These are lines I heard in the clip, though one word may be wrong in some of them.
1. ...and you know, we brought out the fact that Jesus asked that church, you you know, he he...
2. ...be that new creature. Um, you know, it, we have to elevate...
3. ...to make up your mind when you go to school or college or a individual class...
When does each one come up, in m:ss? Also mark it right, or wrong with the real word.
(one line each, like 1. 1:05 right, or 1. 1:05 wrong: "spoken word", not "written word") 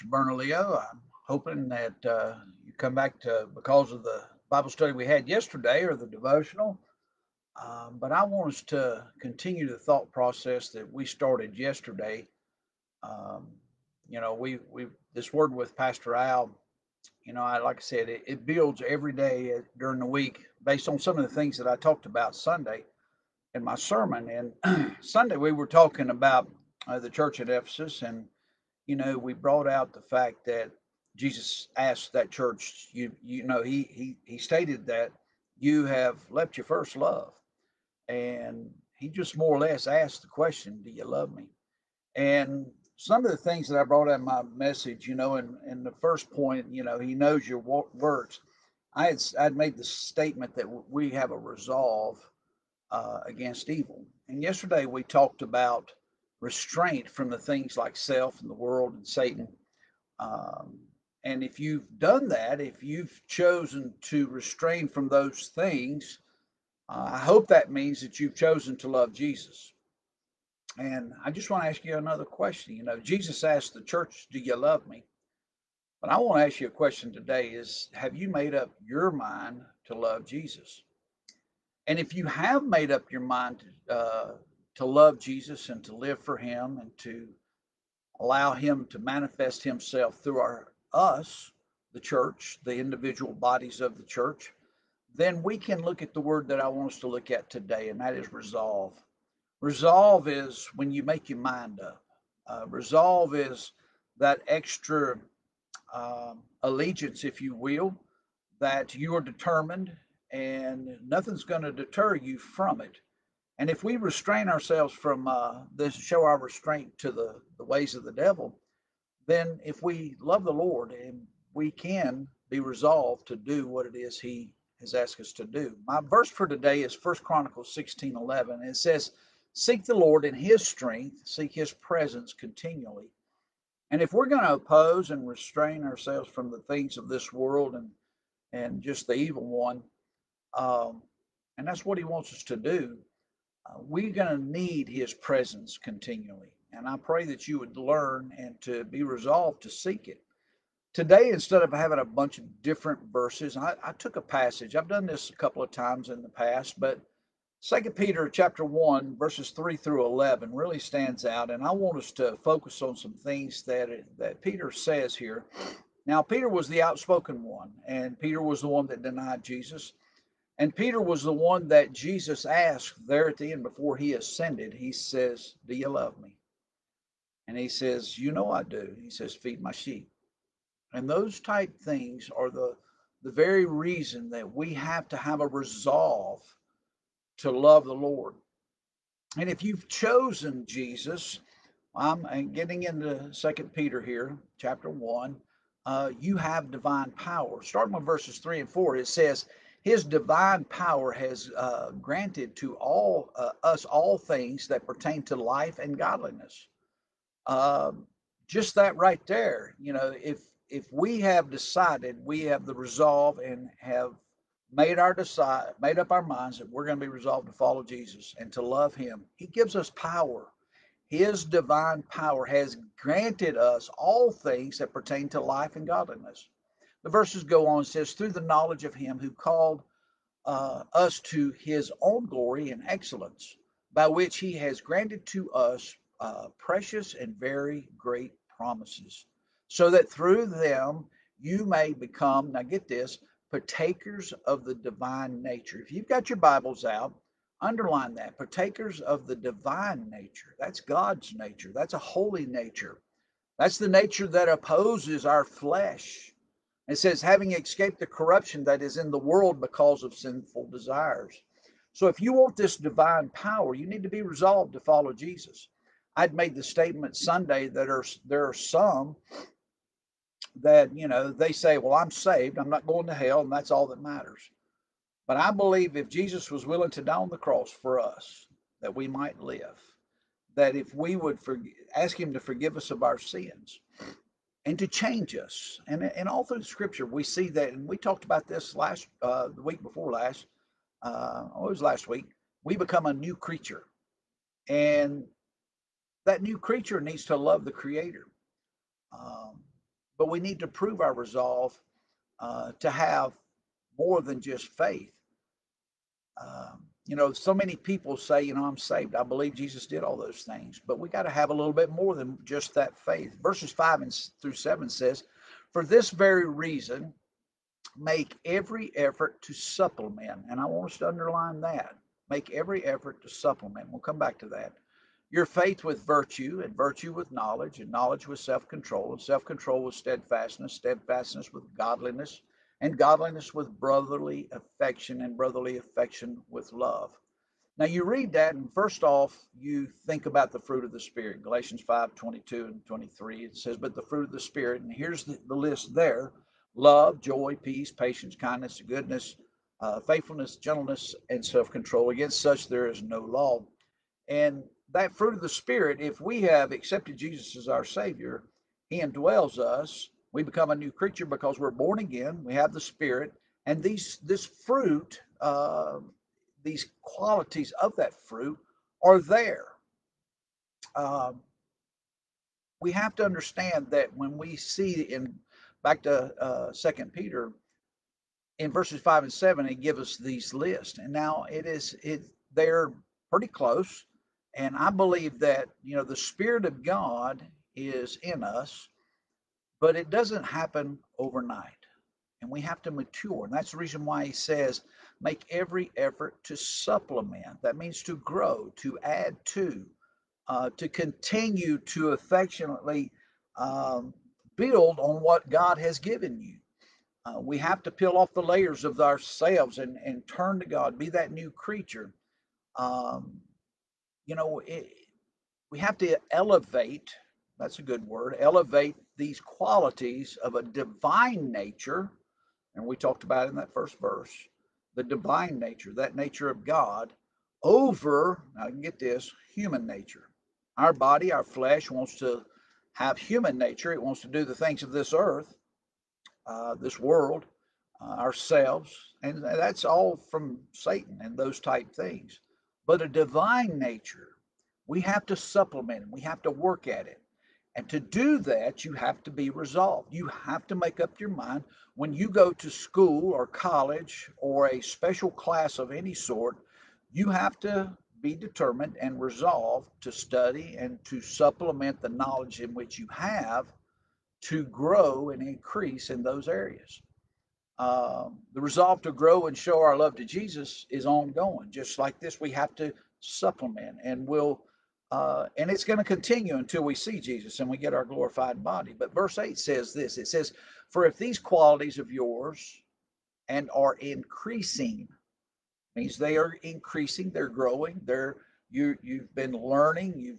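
1. 0:28 right
2. 6:50 right
3. 7:30 wrong: "special", not "individual".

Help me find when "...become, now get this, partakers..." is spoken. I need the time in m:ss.
4:01.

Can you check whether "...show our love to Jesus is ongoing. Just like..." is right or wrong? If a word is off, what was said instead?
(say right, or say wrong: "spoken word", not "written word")
right.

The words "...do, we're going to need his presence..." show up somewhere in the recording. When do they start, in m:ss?
2:22.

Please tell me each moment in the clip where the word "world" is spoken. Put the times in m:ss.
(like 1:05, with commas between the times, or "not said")
0:58, 2:17, 4:19, 7:17.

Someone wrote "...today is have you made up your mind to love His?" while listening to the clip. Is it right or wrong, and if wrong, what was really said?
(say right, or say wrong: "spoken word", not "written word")
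wrong: "Jesus", not "His".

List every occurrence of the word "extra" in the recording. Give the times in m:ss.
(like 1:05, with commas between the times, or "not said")
1:44.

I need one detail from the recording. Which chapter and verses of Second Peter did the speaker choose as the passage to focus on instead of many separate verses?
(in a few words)
Chapter 1, verses 3-11.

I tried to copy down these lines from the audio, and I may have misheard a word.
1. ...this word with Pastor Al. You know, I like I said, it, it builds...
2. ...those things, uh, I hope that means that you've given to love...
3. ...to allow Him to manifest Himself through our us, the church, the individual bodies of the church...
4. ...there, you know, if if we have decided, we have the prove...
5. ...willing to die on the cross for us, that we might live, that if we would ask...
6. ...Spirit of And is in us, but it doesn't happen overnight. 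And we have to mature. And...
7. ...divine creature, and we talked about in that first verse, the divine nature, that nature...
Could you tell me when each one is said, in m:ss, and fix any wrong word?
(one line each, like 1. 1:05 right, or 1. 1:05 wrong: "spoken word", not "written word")
1. 0:15 right
2. 1:05 wrong: "chosen", not "given"
3. 1:26 right
4. 3:29 wrong: "resolve", not "prove"
5. 4:36 right
6. 6:26 wrong: "God", not "And"
7. 7:00 wrong: "nature", not "creature".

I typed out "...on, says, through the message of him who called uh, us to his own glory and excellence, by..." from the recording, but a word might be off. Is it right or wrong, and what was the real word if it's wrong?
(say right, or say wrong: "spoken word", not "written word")
wrong: "knowledge", not "message".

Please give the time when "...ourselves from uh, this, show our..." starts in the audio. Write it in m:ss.
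1:54.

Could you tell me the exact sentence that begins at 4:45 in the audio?
And, and all through Scripture, we see that.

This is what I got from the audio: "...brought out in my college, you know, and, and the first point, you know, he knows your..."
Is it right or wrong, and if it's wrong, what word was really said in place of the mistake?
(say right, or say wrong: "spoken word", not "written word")
wrong: "message", not "college".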